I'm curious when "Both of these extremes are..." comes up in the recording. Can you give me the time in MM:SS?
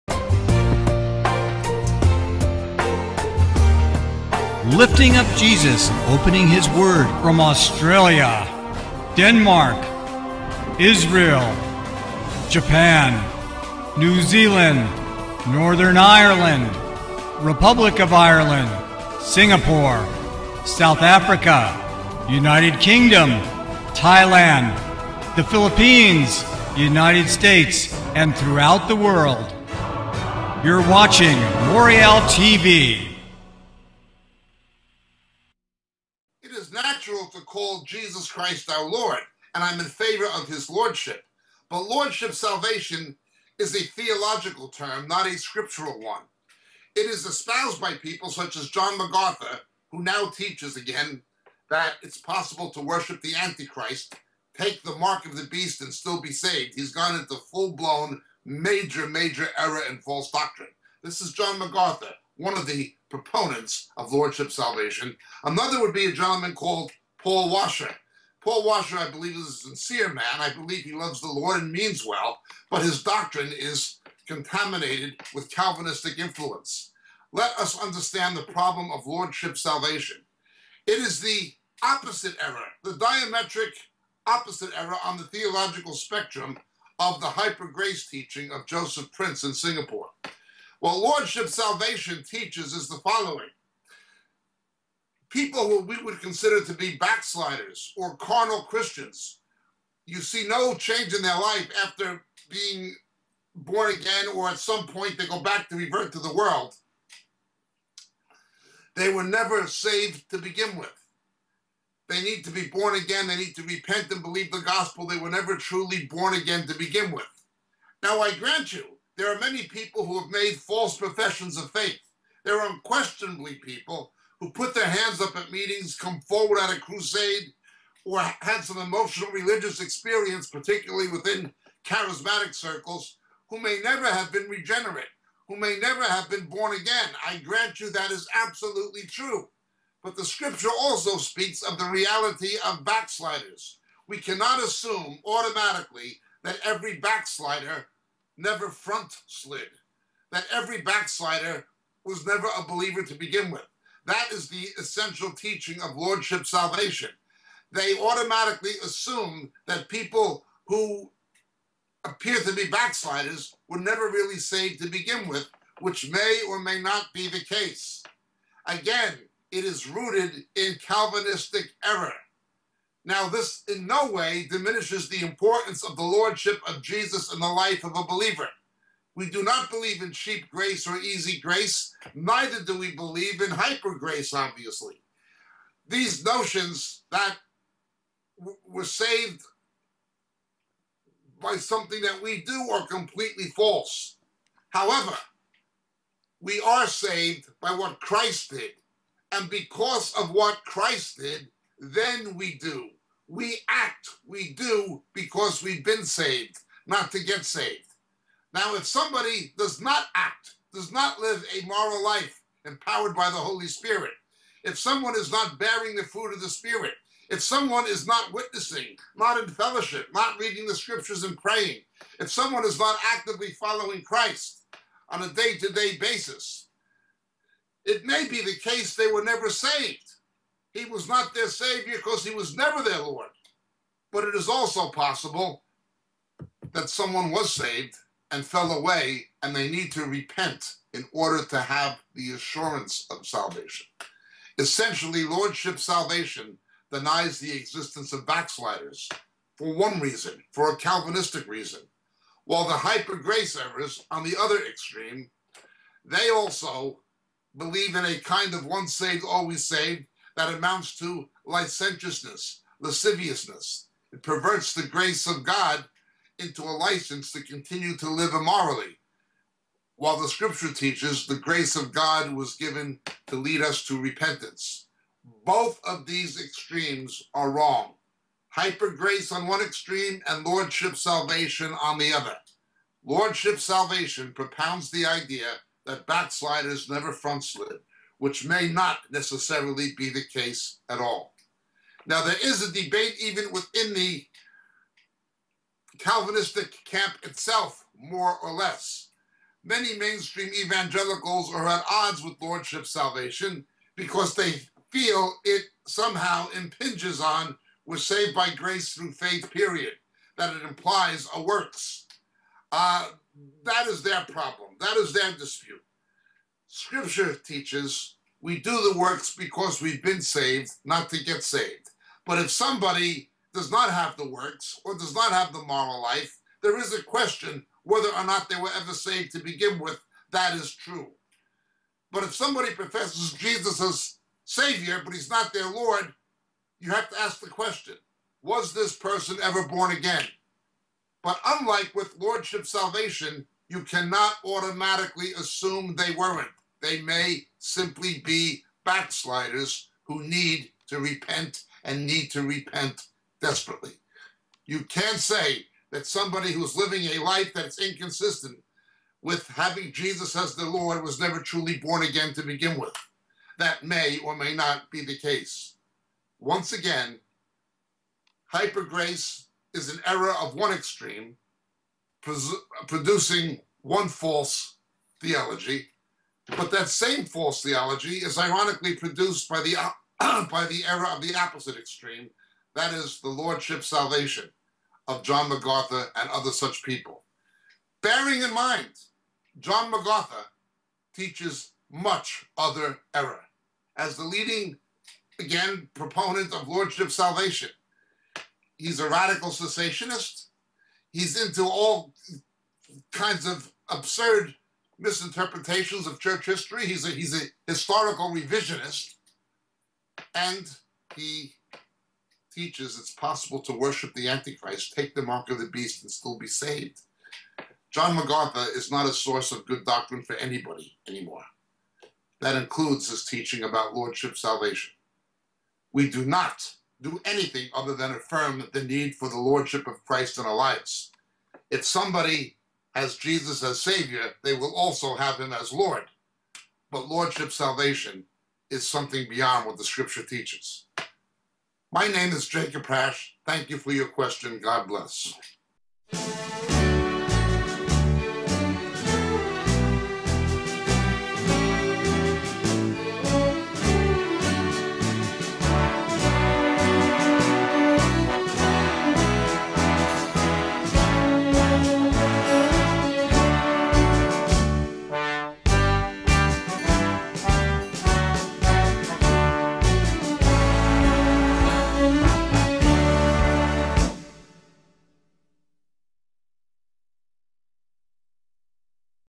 04:35.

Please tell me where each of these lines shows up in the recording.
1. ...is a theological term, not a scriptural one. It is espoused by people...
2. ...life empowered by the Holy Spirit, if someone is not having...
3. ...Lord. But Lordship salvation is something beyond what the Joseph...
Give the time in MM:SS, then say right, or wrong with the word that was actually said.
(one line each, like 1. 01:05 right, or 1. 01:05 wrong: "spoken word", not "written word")
1. 00:43 right
2. 03:32 wrong: "bearing", not "having"
3. 07:15 wrong: "Scripture", not "Joseph".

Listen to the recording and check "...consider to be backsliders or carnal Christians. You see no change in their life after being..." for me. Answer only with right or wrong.
right.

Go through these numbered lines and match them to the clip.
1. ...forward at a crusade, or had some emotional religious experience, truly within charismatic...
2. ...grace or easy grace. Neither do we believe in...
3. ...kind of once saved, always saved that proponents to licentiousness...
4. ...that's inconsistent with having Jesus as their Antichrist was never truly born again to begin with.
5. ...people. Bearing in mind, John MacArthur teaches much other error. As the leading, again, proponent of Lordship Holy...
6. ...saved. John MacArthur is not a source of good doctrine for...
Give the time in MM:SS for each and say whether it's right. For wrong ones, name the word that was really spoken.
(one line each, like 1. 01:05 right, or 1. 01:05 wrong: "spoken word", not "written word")
1. 02:06 wrong: "particularly", not "truly"
2. 03:00 right
3. 04:18 wrong: "amounts", not "proponents"
4. 05:57 wrong: "Lord", not "Antichrist"
5. 06:26 wrong: "Salvation", not "Holy"
6. 06:56 right.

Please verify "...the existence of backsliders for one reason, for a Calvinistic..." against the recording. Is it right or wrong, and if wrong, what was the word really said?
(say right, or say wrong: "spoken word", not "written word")
right.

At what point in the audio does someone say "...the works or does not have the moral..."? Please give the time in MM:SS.
05:24.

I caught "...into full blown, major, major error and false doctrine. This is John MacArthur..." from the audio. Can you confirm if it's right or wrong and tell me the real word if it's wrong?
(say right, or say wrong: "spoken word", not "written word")
right.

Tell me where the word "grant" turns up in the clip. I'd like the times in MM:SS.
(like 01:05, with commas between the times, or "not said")
01:58, 02:17.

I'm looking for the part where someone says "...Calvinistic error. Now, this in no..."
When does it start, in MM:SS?
02:50.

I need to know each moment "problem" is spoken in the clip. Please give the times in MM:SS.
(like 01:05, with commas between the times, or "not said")
01:18, 05:14.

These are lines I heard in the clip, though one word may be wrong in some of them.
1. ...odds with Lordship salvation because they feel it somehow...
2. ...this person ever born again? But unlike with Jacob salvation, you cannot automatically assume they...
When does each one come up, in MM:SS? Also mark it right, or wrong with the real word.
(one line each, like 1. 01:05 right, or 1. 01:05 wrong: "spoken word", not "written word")
1. 05:01 right
2. 05:38 wrong: "Lordship", not "Jacob".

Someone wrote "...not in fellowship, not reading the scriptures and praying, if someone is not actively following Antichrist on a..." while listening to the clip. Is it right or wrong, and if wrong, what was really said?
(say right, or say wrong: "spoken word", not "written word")
wrong: "Christ", not "Antichrist".